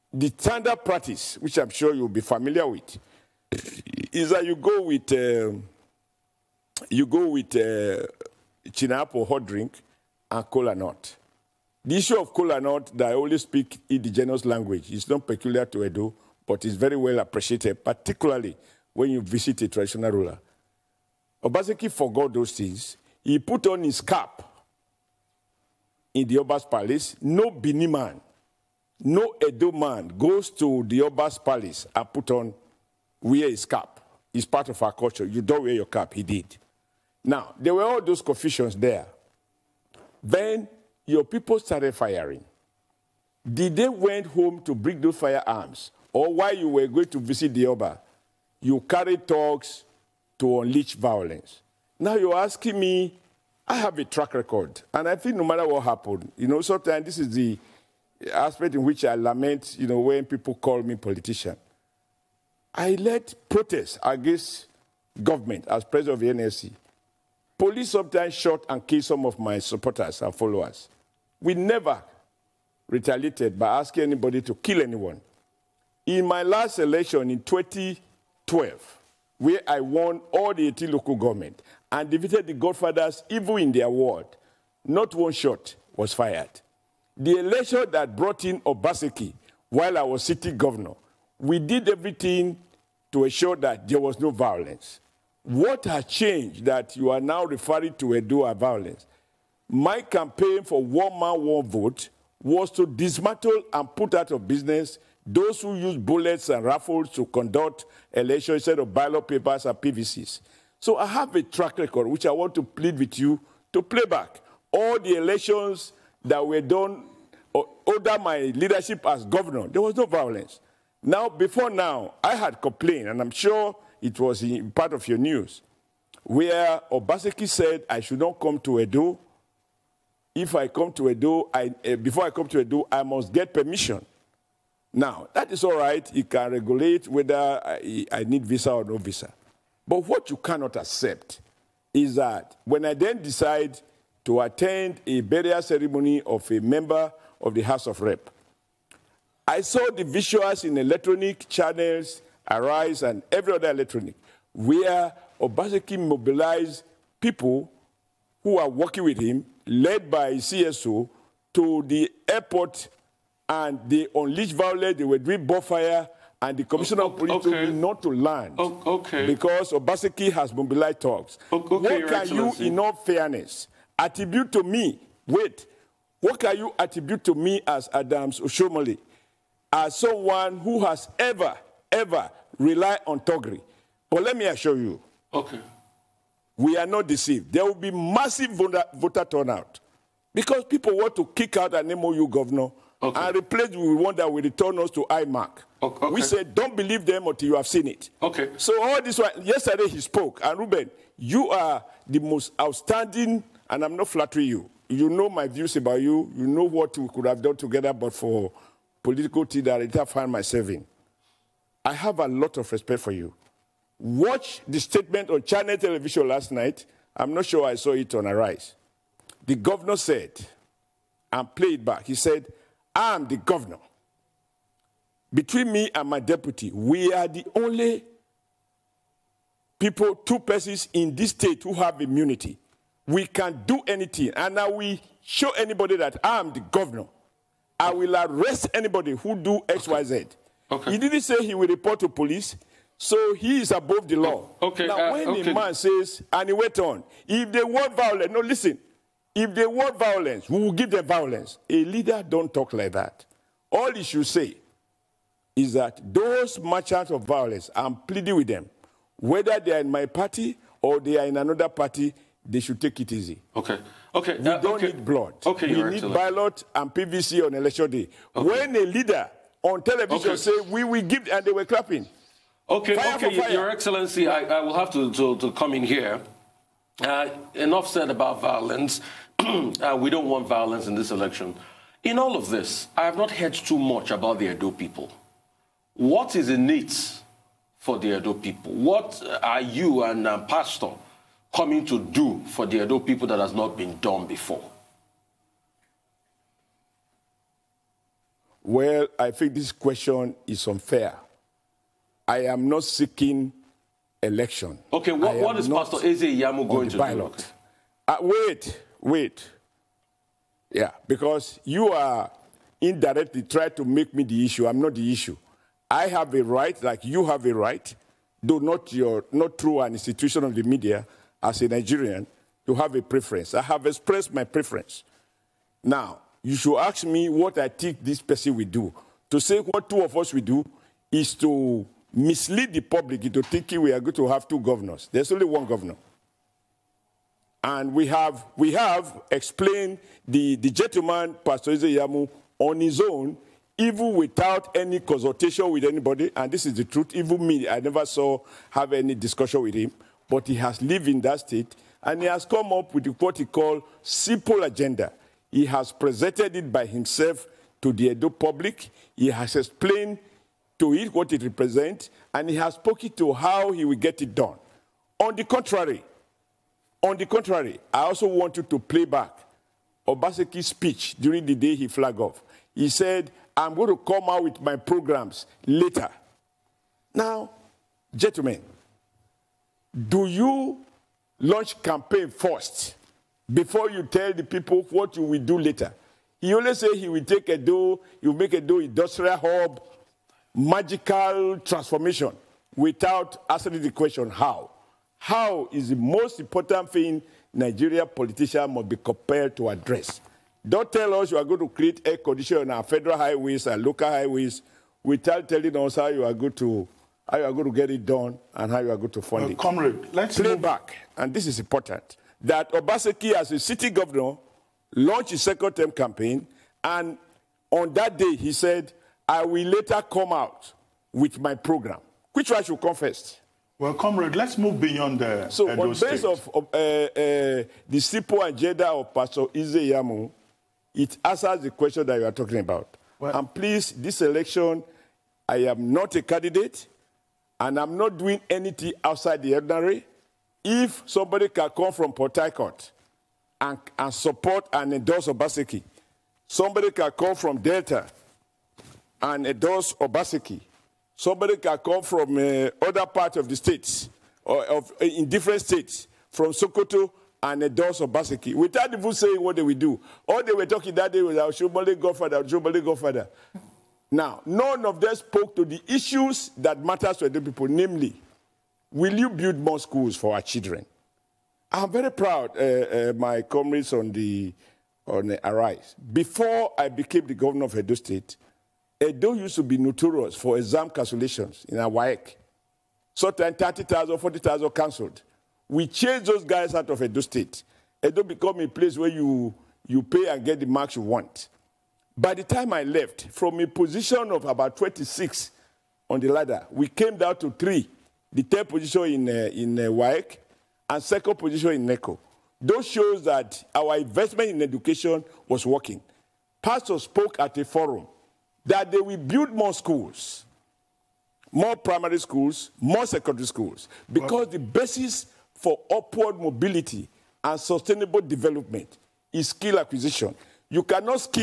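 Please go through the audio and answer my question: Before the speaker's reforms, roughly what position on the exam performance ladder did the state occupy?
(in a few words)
26.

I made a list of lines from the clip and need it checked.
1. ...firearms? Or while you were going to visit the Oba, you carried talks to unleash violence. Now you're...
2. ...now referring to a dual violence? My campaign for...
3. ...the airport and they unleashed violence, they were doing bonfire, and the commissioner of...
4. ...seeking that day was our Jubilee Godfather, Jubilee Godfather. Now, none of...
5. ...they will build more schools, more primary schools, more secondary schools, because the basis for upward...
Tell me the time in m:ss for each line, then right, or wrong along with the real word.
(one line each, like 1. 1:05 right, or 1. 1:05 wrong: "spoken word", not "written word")
1. 0:45 right
2. 1:37 right
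3. 2:41 right
4. 7:40 wrong: "talking", not "seeking"
5. 8:28 right.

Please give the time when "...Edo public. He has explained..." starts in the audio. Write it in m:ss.
5:58.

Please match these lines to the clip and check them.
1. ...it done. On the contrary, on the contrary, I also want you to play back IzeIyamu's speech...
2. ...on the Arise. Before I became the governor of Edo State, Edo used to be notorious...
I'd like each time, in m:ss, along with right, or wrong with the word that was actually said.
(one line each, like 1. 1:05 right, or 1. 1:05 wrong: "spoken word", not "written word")
1. 6:04 wrong: "Obaseki", not "IzeIyamu"
2. 7:55 right.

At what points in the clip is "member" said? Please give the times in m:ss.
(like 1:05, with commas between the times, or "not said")
2:26.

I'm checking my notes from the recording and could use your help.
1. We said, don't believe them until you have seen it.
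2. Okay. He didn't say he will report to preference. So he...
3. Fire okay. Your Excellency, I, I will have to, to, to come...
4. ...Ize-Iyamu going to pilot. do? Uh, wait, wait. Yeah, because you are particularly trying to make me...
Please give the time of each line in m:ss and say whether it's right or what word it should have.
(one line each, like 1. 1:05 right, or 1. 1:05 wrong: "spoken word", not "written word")
1. 3:16 right
2. 4:00 wrong: "police", not "preference"
3. 4:32 right
4. 5:06 wrong: "indirectly", not "particularly".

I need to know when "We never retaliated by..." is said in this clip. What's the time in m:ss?
1:11.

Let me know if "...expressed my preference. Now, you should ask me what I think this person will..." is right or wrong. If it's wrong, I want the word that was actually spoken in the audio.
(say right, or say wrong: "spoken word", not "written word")
right.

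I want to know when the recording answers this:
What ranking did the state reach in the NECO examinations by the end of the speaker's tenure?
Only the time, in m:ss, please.
8:21.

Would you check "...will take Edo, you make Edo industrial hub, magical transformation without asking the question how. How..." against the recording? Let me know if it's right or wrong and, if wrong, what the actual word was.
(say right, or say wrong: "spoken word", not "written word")
right.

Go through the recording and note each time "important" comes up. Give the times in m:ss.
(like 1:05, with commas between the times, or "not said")
6:36, 6:51.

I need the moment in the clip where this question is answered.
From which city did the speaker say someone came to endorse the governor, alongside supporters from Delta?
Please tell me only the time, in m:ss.
7:22.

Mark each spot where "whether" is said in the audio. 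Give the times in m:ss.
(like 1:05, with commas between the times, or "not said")
2:17, 4:19.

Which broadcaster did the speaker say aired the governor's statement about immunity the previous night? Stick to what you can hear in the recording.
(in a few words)
Channel Television.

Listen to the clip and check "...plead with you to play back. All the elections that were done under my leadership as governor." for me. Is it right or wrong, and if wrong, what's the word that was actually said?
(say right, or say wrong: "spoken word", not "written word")
right.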